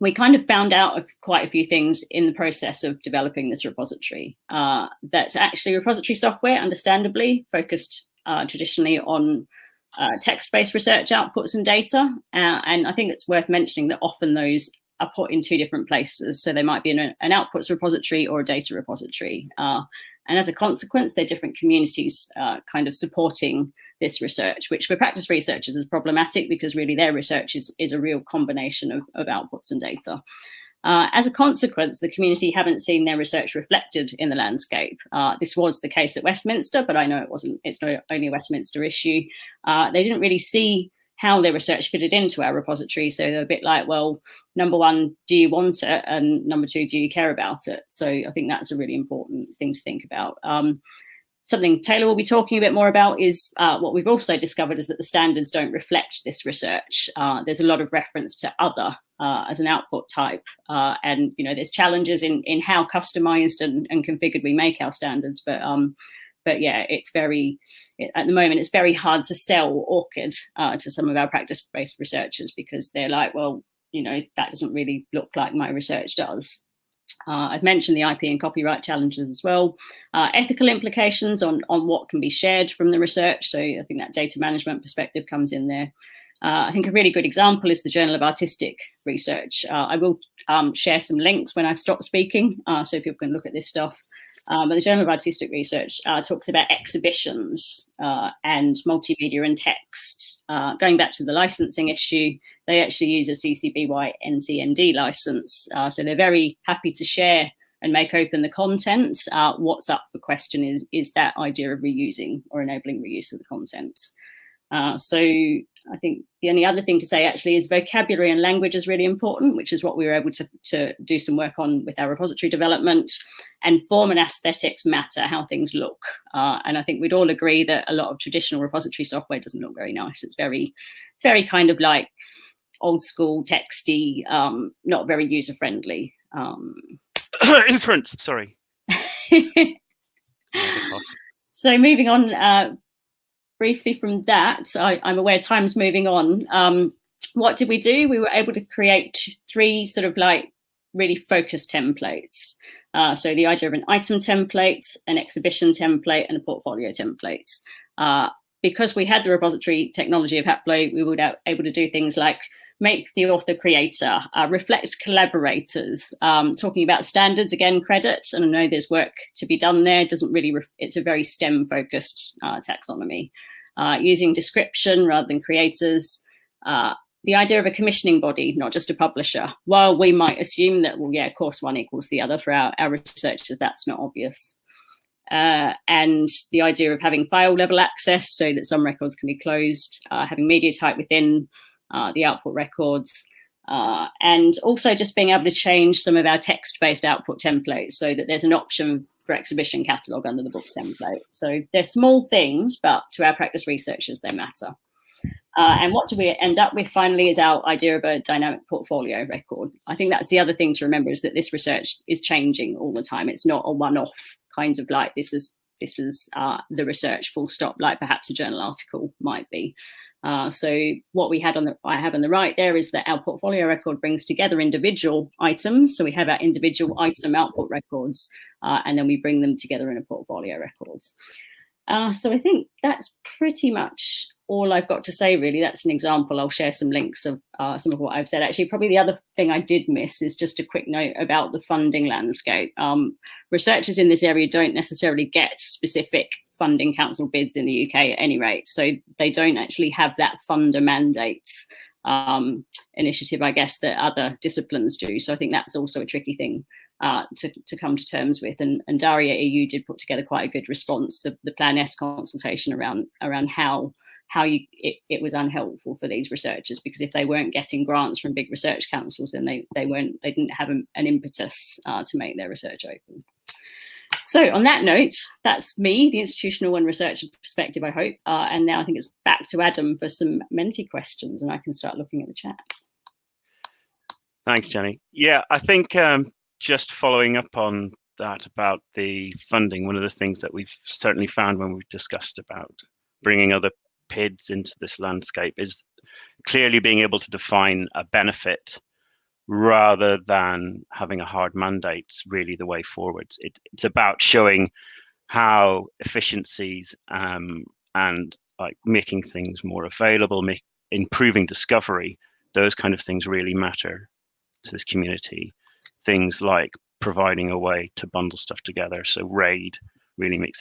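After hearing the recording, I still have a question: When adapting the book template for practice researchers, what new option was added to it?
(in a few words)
Exhibition catalogue.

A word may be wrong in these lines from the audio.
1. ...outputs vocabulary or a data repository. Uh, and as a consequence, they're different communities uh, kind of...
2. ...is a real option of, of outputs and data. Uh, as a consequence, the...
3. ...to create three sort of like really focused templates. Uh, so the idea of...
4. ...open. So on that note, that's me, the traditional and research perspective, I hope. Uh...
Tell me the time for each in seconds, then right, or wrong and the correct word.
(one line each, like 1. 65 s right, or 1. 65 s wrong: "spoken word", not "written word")
1. 17 s wrong: "repository", not "vocabulary"
2. 27 s wrong: "combination", not "option"
3. 148 s right
4. 272 s wrong: "institutional", not "traditional".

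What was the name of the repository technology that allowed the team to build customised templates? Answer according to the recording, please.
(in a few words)
Haplo.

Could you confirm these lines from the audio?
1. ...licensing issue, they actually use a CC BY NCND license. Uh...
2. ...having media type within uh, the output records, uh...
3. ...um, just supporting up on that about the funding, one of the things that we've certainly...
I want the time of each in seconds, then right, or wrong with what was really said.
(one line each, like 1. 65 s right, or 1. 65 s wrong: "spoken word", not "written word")
1. 101 s right
2. 190 s right
3. 285 s wrong: "following", not "supporting".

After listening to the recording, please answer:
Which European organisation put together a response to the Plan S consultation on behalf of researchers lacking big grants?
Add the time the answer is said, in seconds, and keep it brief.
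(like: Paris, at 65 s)
DARIAH-EU, at 258 s.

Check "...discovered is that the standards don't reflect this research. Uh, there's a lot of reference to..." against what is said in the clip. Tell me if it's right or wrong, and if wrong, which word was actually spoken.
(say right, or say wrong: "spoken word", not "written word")
right.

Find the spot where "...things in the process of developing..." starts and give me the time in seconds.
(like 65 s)
1 s.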